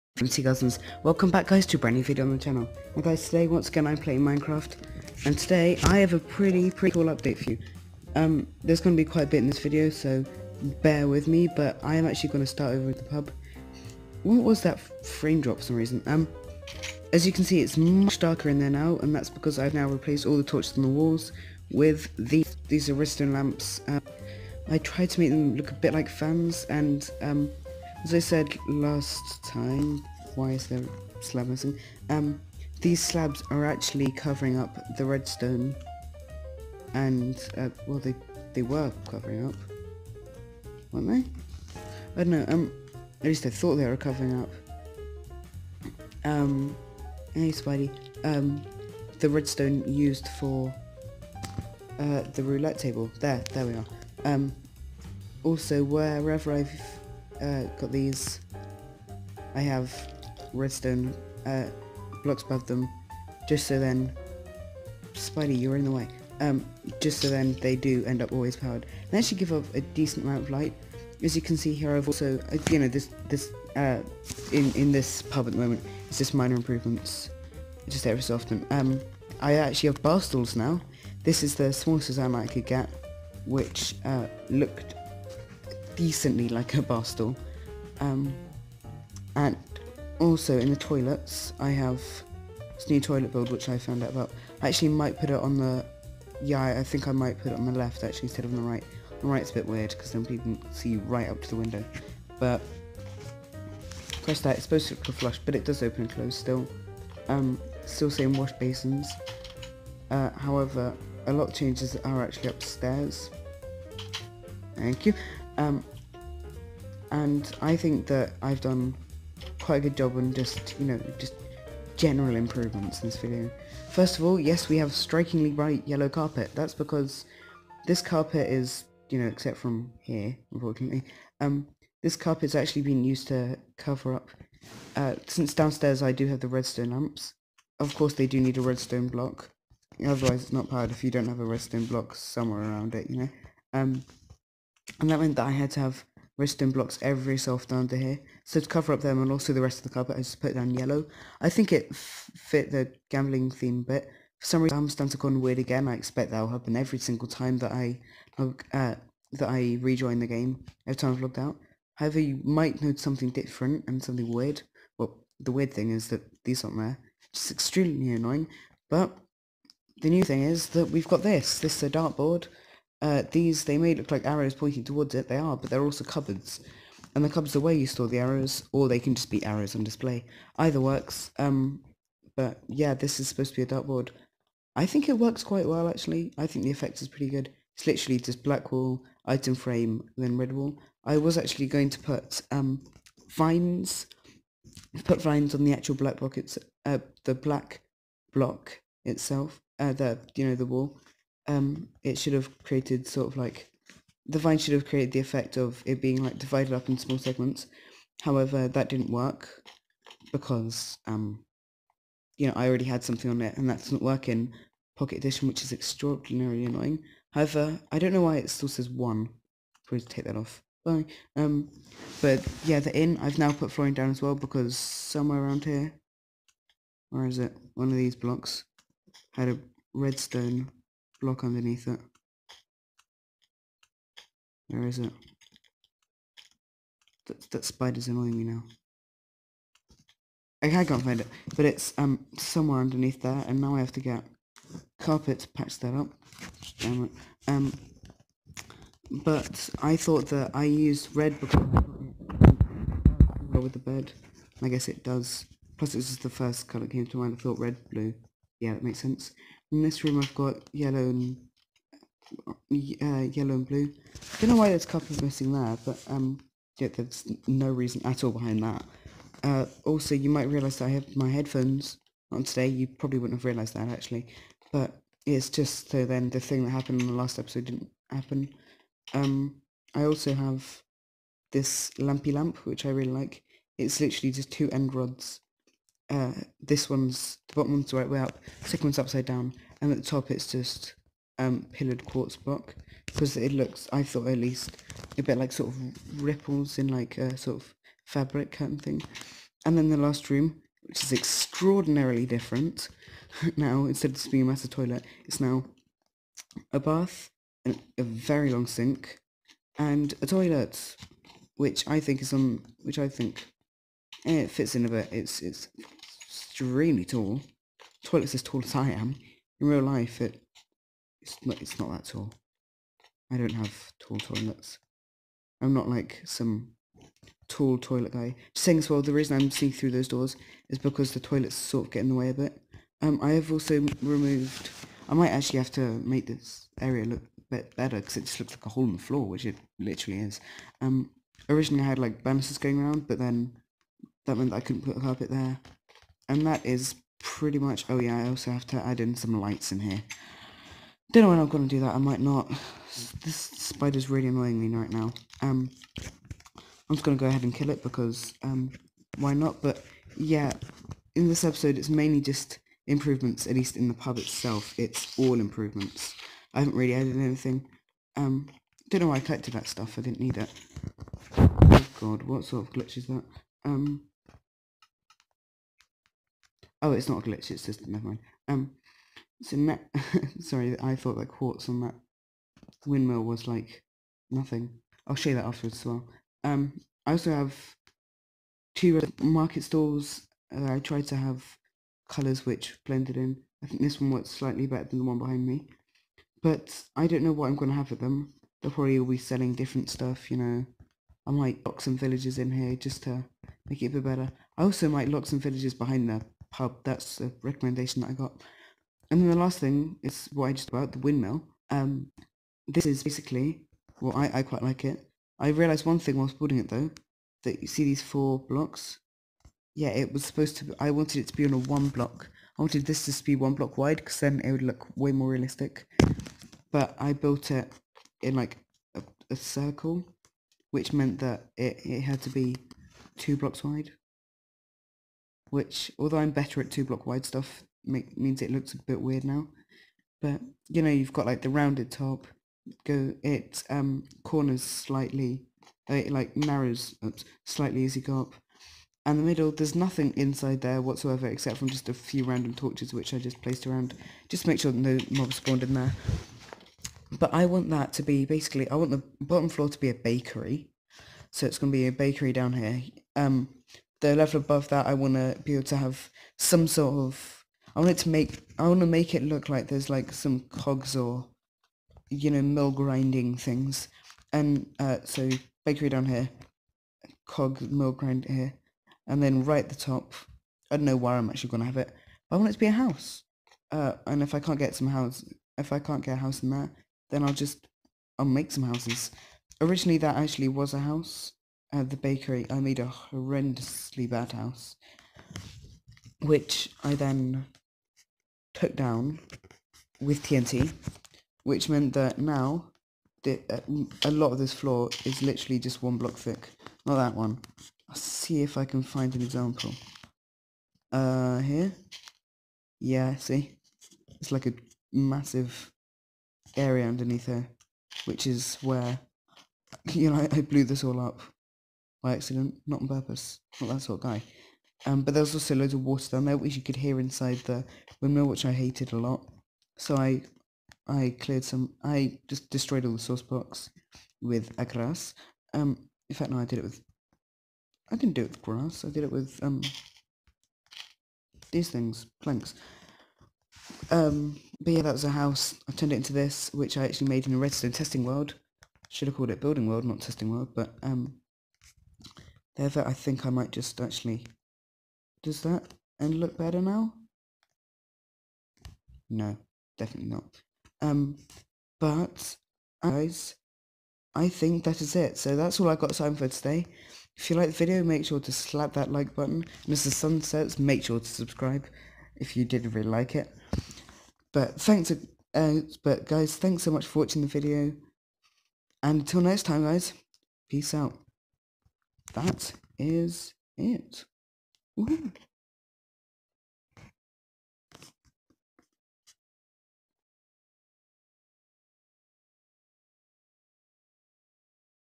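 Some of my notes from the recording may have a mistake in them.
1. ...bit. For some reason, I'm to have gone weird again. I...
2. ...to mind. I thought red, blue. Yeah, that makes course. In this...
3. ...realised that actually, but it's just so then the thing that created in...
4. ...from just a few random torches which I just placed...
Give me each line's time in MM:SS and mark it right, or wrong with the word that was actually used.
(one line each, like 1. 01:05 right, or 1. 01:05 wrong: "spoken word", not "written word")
1. 02:33 right
2. 04:17 wrong: "sense", not "course"
3. 04:33 wrong: "happened", not "created"
4. 07:31 right.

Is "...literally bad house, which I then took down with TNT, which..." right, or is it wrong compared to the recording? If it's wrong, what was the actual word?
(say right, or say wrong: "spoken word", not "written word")
wrong: "horrendously", not "literally".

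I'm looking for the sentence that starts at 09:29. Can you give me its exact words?
And as the sun sets, make sure to subscribe if you did really like it.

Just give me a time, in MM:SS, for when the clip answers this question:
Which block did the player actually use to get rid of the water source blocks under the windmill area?
09:02.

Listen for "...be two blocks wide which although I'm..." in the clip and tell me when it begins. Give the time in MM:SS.
07:12.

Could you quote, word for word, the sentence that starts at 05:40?
Um, originally I had like banisters going around, but then that meant that I couldn't put a carpet there.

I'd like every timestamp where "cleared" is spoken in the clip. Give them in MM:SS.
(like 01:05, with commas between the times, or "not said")
08:51.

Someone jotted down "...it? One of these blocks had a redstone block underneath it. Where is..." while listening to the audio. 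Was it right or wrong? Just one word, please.
right.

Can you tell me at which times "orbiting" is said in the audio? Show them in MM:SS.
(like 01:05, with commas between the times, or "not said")
not said.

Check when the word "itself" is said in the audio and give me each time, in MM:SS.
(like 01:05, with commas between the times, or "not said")
03:19, 06:04.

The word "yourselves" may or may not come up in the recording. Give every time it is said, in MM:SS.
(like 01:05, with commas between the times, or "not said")
not said.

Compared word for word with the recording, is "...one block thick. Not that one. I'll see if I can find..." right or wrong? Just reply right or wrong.
right.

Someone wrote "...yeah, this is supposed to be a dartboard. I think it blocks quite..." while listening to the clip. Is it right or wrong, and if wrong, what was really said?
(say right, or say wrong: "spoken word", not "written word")
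wrong: "works", not "blocks".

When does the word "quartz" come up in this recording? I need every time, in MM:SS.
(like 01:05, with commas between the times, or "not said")
04:52, 06:21.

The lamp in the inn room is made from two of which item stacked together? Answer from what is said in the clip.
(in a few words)
End rods.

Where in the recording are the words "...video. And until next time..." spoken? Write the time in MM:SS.
09:37.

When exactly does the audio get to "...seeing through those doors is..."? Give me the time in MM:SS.
05:29.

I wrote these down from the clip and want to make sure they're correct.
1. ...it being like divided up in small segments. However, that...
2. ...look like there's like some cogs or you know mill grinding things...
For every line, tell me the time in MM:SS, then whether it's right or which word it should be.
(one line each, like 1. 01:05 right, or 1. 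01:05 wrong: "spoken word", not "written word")
1. 03:25 right
2. 07:49 right.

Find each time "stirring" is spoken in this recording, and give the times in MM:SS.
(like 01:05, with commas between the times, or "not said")
not said.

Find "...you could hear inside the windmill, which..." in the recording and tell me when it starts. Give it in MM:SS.
08:46.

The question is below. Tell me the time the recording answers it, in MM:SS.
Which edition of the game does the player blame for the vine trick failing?
03:34.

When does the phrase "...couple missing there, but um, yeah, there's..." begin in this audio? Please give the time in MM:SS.
04:24.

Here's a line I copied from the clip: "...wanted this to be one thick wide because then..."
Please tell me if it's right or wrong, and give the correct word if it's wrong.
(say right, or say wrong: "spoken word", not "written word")
wrong: "block", not "thick".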